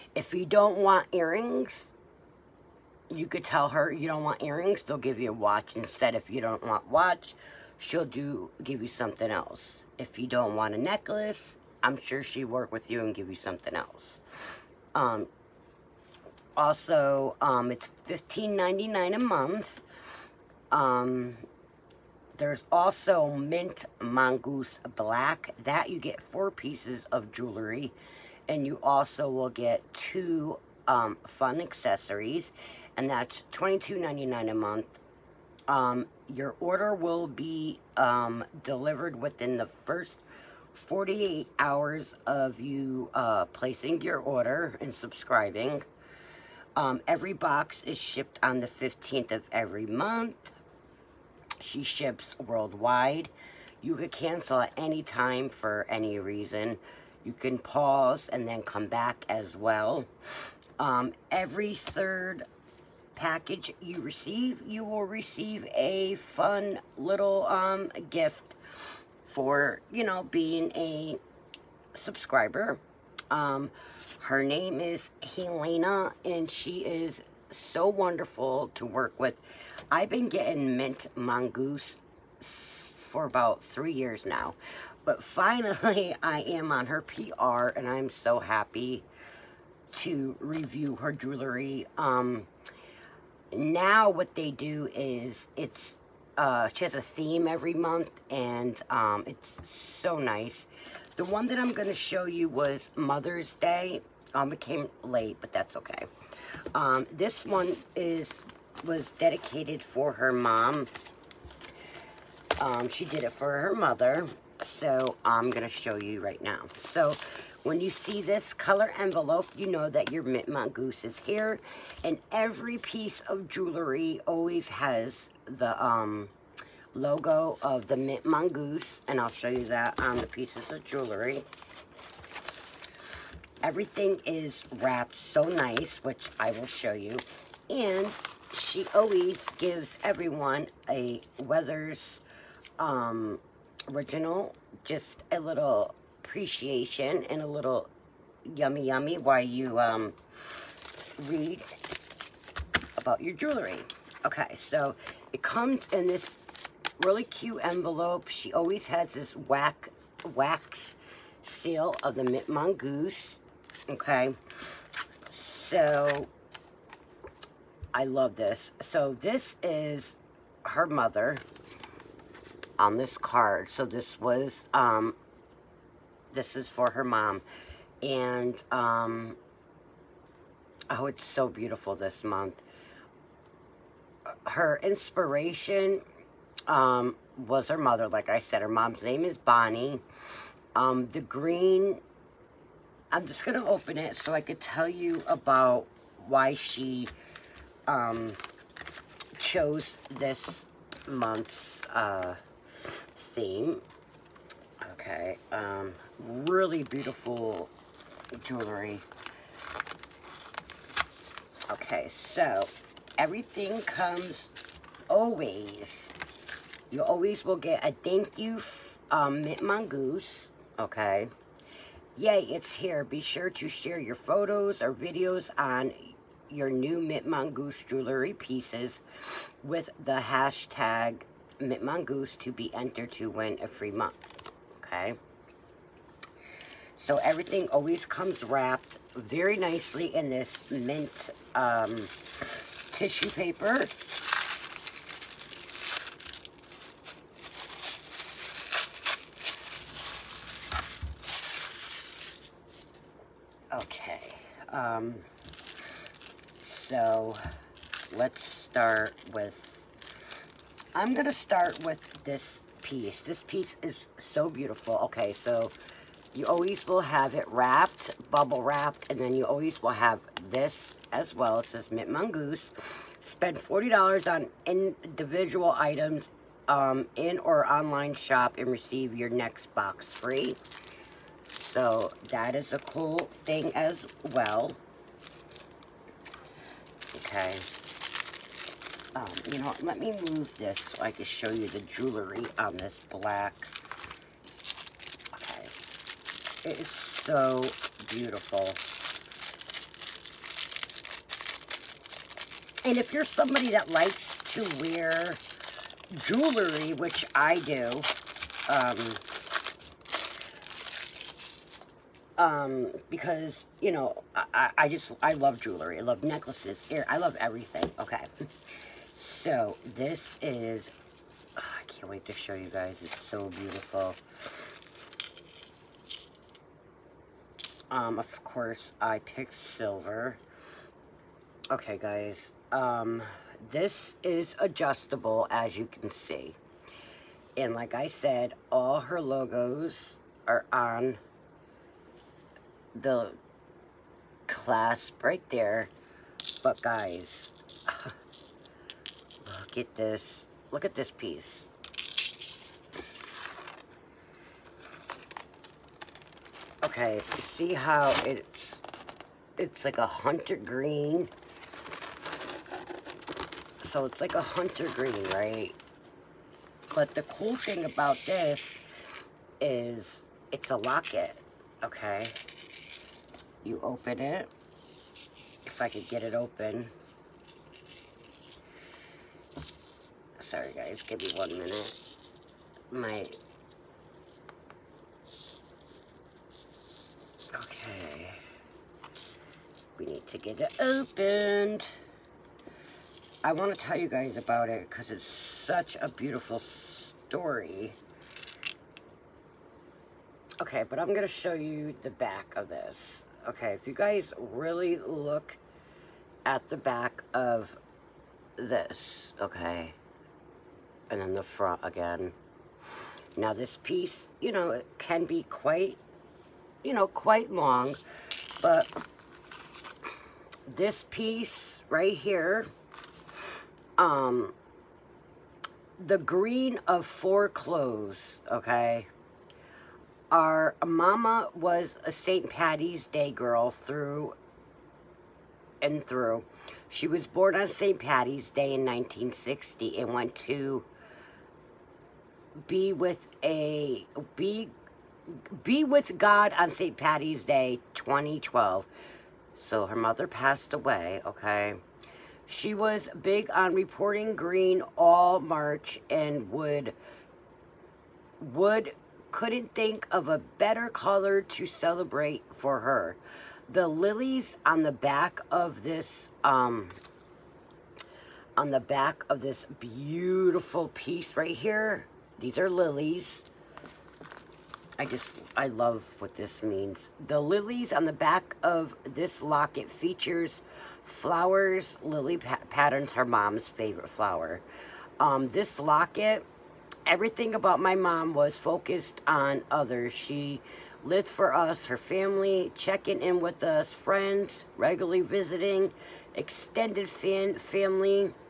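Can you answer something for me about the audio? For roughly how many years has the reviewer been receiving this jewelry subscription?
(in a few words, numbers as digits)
About three years.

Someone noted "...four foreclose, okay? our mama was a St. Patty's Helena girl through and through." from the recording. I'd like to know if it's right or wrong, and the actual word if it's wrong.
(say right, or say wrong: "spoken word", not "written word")
wrong: "Day", not "Helena".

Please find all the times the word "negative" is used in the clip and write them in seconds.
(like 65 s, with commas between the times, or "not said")
not said.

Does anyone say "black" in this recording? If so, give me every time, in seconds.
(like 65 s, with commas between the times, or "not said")
24 s, 292 s.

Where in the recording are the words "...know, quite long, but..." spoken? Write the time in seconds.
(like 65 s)
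416 s.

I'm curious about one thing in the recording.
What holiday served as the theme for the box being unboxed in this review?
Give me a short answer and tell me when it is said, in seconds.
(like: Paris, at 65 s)
Mother's Day, at 102 s.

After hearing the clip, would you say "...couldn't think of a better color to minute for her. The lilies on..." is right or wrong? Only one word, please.
wrong.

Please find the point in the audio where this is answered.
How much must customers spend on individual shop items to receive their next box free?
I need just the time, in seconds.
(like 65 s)
273 s.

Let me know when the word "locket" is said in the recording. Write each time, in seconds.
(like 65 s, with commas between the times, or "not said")
370 s, 479 s, 485 s.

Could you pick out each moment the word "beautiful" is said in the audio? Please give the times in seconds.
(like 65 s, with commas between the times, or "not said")
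181 s, 206 s, 264 s, 298 s, 323 s, 396 s, 469 s.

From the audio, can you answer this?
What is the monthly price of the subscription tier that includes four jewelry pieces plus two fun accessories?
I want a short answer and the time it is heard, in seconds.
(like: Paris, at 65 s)
$22.99, at 33 s.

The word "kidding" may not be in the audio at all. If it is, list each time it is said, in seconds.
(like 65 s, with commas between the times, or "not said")
not said.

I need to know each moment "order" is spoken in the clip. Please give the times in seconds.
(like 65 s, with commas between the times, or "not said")
36 s, 44 s.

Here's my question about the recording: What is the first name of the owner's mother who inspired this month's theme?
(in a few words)
Bonnie.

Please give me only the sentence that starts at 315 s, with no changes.
I love necklaces, ear, I love everything.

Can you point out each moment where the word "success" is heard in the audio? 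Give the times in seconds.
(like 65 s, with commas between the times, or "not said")
not said.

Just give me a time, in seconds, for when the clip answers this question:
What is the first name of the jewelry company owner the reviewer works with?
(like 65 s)
74 s.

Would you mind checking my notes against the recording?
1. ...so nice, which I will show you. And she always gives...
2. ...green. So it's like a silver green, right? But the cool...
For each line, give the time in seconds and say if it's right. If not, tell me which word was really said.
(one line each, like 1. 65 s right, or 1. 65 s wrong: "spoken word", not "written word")
1. 135 s right
2. 360 s wrong: "hunter", not "silver".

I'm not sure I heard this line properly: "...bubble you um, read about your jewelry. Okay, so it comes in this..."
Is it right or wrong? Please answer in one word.
wrong.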